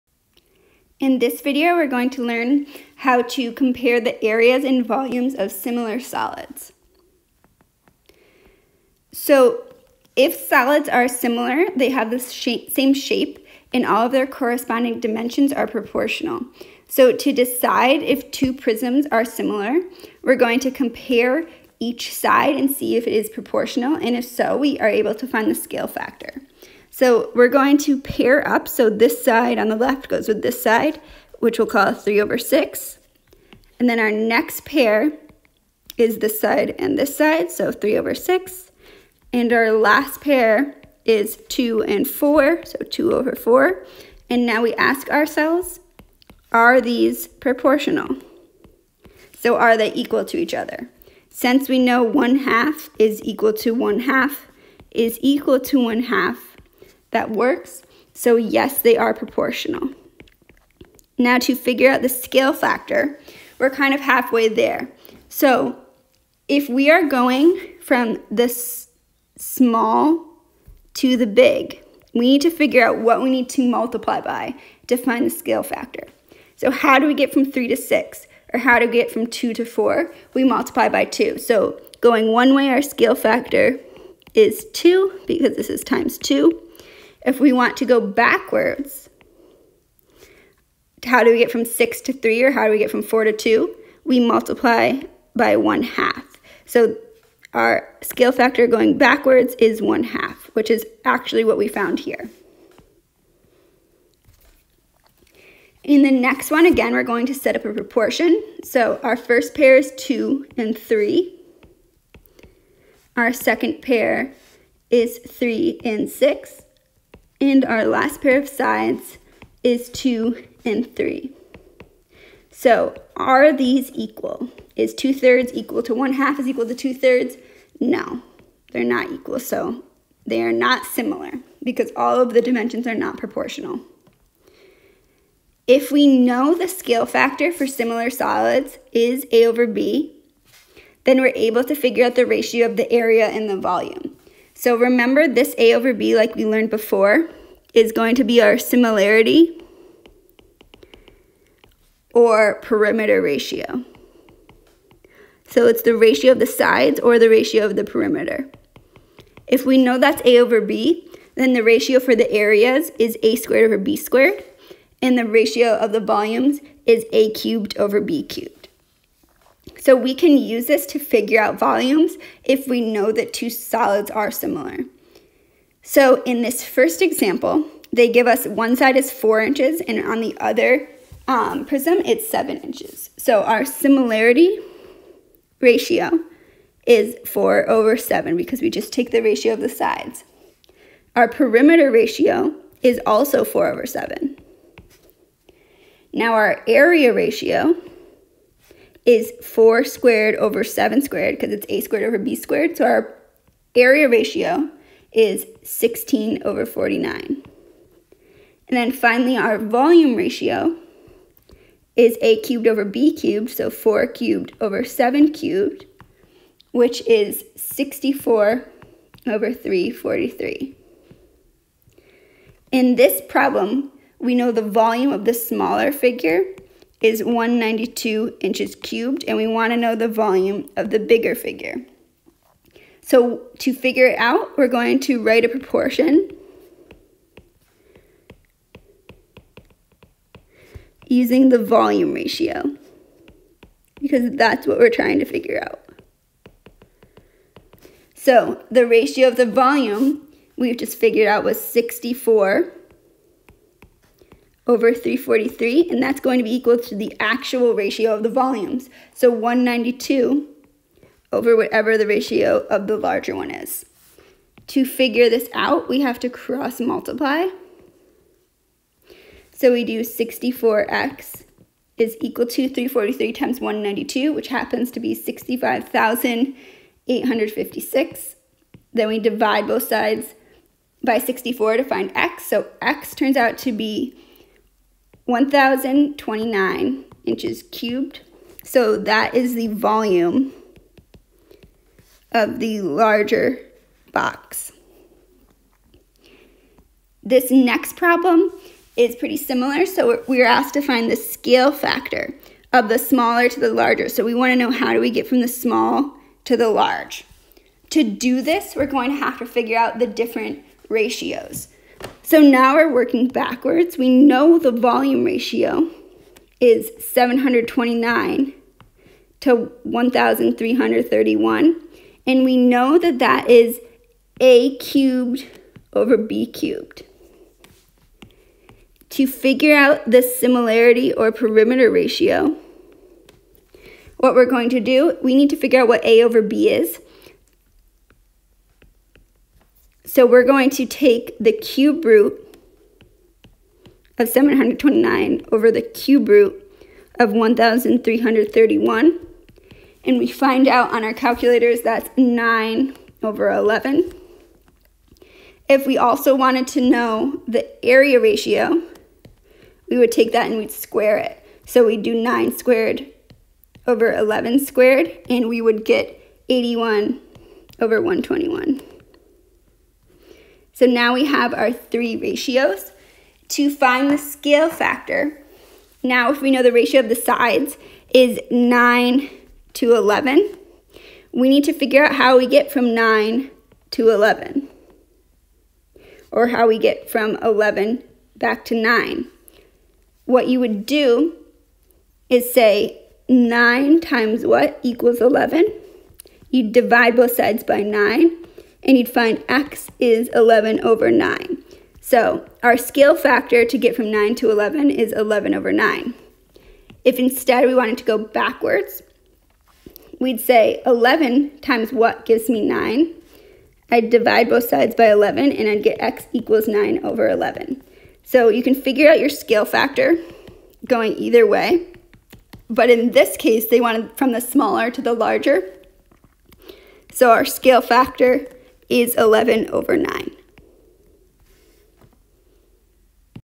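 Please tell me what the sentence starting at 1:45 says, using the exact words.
In the next one, again, we're going to set up a proportion.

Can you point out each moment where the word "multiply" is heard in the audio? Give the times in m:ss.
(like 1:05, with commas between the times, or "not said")
1:13, 1:20, 1:34, 4:26.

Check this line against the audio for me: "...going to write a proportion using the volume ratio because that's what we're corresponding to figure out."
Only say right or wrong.
wrong.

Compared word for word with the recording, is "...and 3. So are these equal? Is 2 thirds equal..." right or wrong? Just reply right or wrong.
right.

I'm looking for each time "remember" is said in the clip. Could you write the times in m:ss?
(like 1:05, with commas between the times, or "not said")
2:24.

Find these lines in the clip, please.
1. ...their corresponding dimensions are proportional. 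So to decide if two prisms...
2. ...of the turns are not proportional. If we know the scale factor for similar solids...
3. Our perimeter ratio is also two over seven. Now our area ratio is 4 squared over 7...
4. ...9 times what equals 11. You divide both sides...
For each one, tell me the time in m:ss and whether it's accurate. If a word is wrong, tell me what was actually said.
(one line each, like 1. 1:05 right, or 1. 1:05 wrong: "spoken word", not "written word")
1. 0:14 right
2. 2:12 wrong: "dimensions", not "turns"
3. 3:11 wrong: "four", not "two"
4. 6:33 right.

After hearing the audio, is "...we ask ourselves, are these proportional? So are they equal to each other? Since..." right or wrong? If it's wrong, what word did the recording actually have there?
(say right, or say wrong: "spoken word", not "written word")
right.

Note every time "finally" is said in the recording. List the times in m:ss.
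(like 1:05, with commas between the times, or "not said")
3:28.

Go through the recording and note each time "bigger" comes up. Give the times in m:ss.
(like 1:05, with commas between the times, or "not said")
3:50.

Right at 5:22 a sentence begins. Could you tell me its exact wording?
And we know that that is a cubed over b cubed.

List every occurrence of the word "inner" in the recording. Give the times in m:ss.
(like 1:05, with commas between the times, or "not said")
not said.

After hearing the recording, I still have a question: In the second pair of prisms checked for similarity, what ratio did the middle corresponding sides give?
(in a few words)
3 over 6.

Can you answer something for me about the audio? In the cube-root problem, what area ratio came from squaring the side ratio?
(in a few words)
81/121.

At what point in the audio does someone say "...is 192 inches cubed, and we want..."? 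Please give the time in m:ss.
3:47.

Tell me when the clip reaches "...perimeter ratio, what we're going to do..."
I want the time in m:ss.
5:31.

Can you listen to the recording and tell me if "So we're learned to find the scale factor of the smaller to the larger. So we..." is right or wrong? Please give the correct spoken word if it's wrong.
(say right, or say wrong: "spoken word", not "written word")
wrong: "asked", not "learned".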